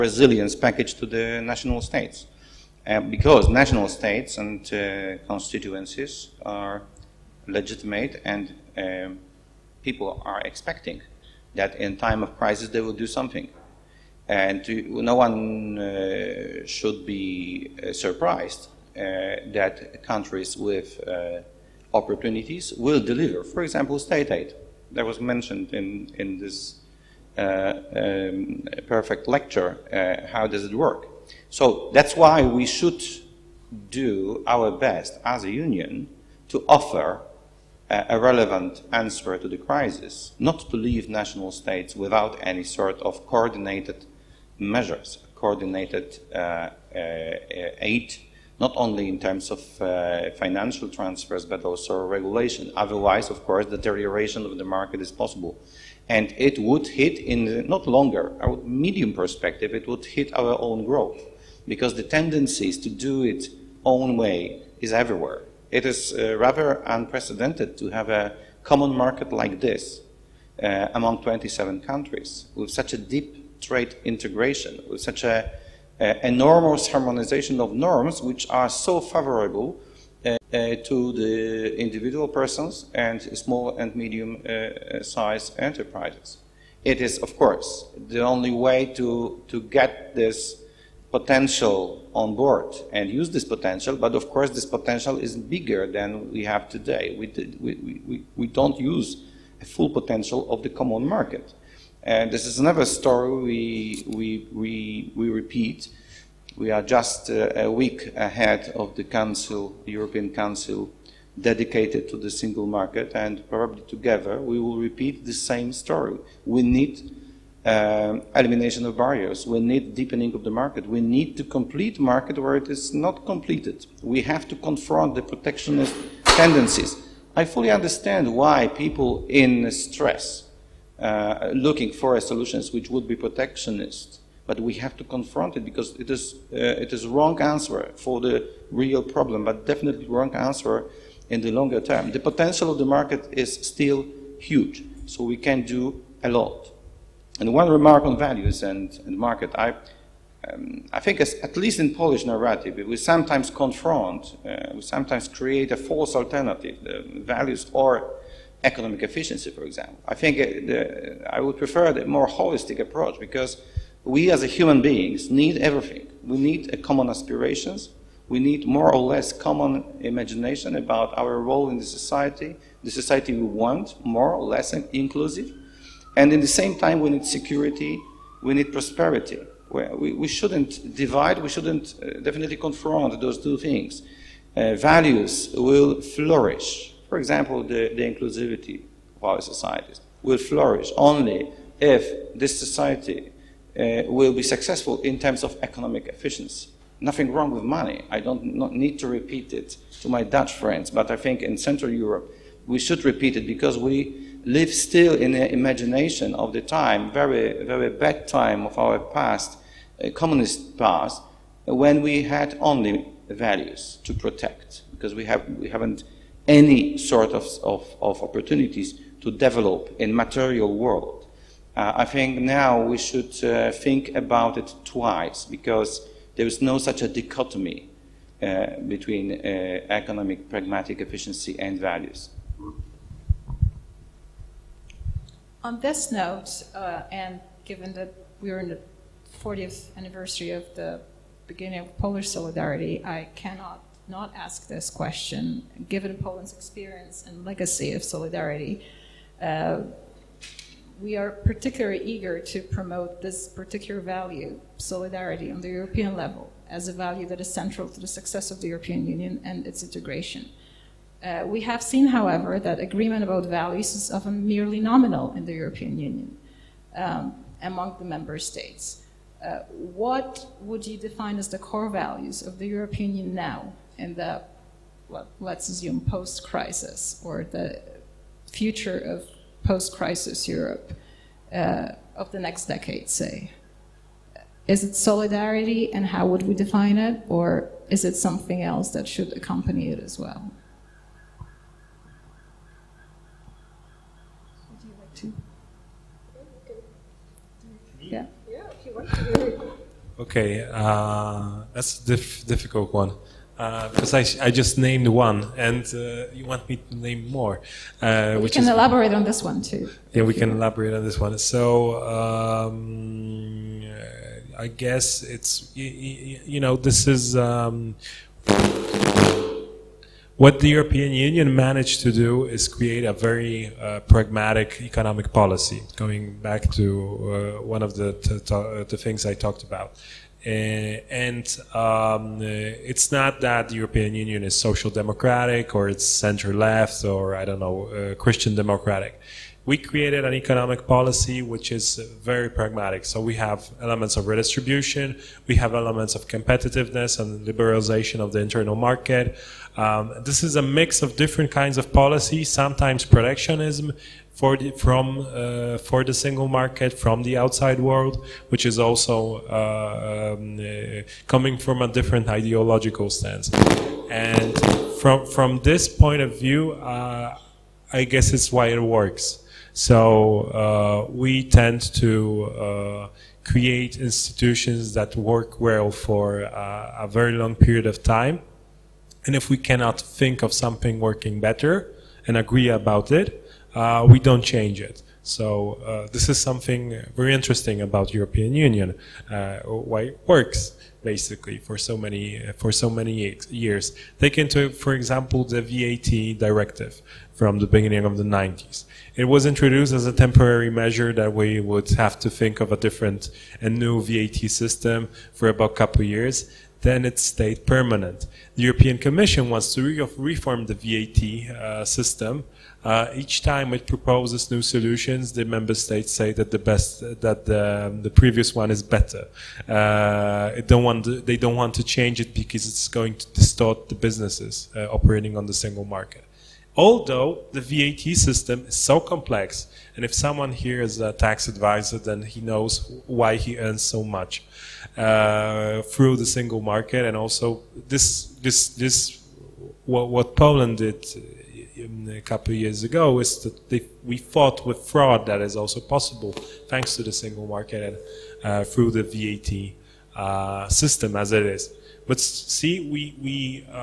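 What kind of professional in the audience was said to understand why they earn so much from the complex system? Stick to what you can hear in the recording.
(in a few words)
tax advisor.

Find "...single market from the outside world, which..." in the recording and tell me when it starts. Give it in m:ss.
5:56.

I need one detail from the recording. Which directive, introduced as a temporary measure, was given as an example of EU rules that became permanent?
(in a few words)
the VAT directive.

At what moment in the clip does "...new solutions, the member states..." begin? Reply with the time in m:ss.
6:54.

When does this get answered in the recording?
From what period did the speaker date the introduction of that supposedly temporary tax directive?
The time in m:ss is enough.
6:37.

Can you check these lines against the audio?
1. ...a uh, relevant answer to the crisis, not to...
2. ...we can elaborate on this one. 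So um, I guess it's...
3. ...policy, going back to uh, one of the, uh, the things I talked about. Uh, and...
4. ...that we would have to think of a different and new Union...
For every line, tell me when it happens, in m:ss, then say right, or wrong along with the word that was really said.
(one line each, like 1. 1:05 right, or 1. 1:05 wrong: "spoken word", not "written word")
1. 0:37 right
2. 5:10 right
3. 5:25 right
4. 6:41 wrong: "VAT", not "Union".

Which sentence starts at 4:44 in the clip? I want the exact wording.
Is it solidarity and how would we define it?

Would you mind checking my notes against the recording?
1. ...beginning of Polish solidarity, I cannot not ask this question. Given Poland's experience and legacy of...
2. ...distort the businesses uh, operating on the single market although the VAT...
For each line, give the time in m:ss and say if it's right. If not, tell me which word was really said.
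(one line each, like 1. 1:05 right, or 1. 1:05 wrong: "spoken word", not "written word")
1. 4:01 right
2. 7:03 right.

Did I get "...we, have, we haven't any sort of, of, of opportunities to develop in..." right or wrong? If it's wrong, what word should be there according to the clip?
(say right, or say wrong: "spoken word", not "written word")
right.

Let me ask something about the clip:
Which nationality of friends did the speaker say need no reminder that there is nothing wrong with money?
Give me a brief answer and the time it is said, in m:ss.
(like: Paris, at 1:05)
Dutch, at 3:20.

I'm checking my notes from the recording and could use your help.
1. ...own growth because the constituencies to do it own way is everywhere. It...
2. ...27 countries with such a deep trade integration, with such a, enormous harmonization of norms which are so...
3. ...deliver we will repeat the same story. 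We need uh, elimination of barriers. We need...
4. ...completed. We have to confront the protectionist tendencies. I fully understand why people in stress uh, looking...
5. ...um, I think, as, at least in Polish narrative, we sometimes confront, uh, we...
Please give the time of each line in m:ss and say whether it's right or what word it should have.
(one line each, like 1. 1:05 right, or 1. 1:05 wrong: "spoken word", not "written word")
1. 1:00 wrong: "tendencies", not "constituencies"
2. 1:11 right
3. 1:53 wrong: "together", not "deliver"
4. 2:03 right
5. 2:30 right.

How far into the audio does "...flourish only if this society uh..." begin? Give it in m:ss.
3:10.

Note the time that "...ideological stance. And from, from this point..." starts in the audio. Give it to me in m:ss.
6:02.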